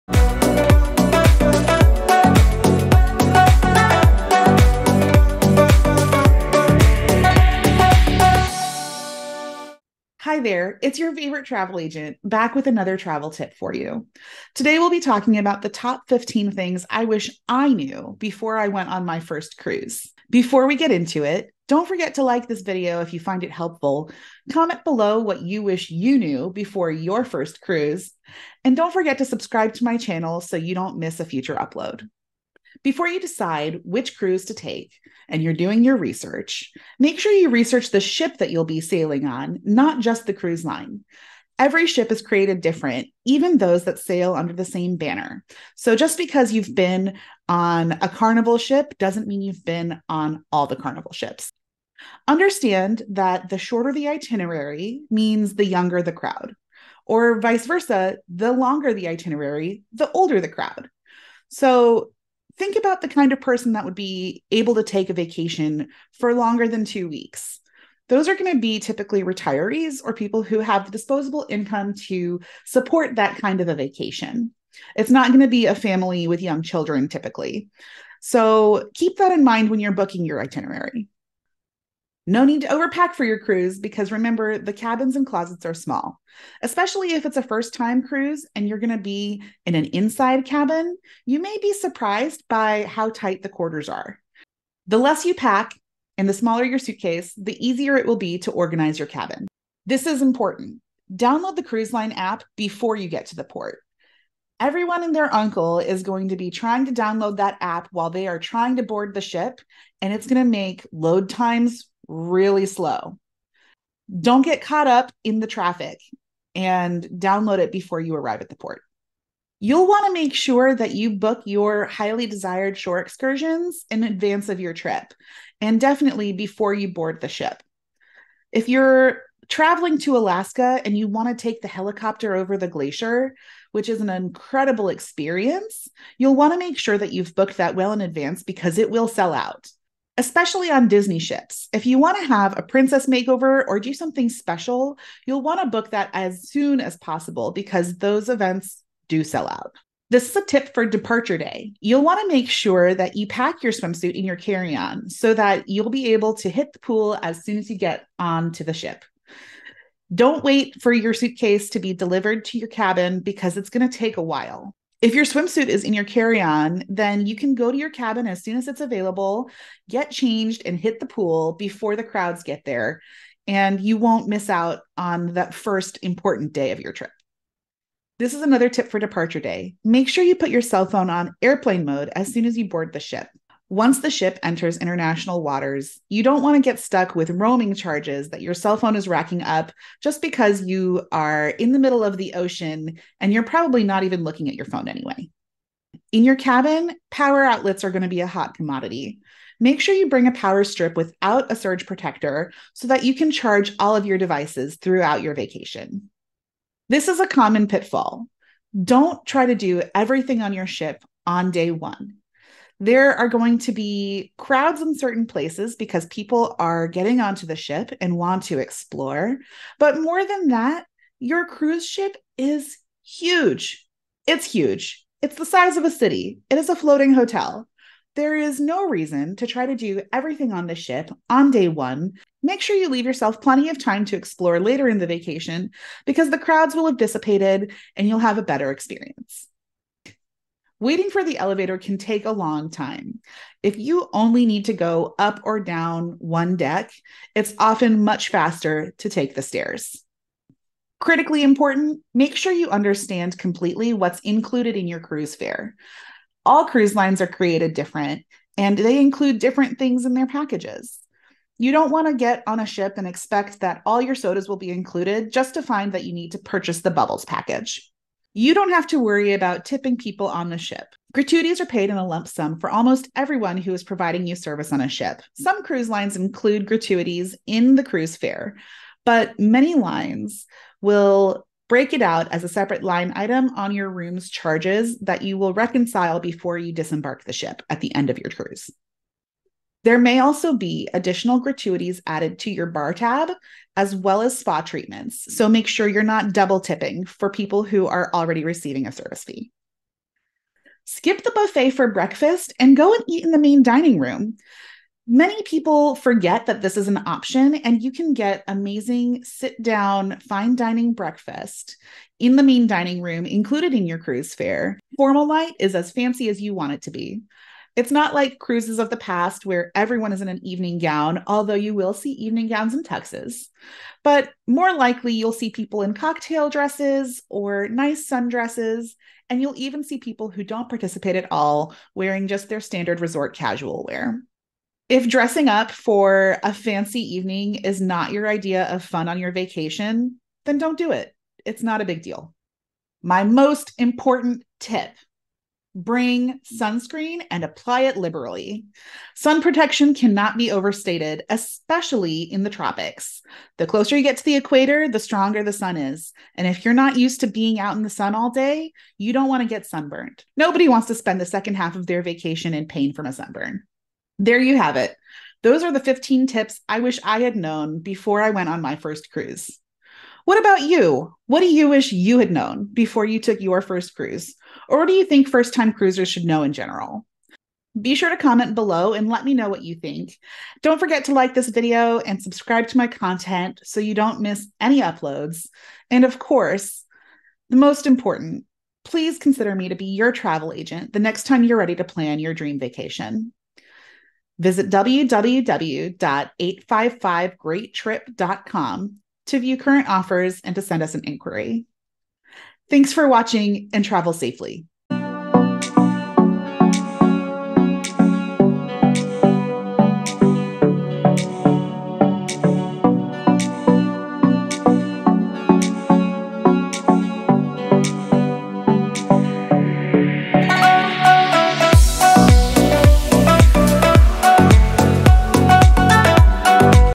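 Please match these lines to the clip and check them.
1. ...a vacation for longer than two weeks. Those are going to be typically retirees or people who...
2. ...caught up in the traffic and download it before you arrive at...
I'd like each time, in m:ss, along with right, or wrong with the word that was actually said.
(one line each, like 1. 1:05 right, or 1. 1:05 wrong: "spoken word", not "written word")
1. 1:05 right
2. 1:54 right.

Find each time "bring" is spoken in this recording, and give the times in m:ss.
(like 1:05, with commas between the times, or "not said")
3:20, 5:45.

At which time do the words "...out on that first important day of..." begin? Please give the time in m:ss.
2:54.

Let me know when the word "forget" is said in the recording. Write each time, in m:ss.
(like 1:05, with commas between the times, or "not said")
0:21, 0:28, 5:05, 6:20.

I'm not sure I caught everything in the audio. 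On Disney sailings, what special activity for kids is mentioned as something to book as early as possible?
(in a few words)
Princess makeover.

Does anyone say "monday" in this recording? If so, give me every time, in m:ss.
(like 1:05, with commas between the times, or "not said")
not said.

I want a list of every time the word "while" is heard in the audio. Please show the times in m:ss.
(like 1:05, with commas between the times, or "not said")
1:47, 2:44.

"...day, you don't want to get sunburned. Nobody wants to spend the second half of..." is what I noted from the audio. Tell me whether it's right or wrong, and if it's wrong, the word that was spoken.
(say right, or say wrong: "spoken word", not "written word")
right.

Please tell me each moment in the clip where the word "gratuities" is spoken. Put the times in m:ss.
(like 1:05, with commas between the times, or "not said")
4:31, 4:36, 4:51.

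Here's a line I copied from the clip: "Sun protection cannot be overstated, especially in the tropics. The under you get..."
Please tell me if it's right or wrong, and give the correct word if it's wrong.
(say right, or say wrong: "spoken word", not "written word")
wrong: "closer", not "under".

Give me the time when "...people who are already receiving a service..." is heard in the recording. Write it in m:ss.
4:57.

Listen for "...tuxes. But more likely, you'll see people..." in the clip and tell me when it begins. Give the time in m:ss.
5:22.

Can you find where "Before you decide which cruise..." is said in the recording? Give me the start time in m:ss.
0:32.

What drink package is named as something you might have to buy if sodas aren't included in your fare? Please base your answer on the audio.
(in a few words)
Bubbles package.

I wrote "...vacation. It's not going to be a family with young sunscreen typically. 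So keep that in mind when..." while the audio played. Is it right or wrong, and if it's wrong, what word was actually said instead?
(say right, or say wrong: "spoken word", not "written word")
wrong: "children", not "sunscreen".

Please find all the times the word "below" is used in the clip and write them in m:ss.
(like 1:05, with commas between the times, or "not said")
0:24, 6:18.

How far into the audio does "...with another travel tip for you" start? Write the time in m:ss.
0:12.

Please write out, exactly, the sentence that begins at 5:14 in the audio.
Formal light is as fancy as you want it to be.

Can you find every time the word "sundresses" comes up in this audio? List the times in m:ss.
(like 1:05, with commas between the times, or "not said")
5:28.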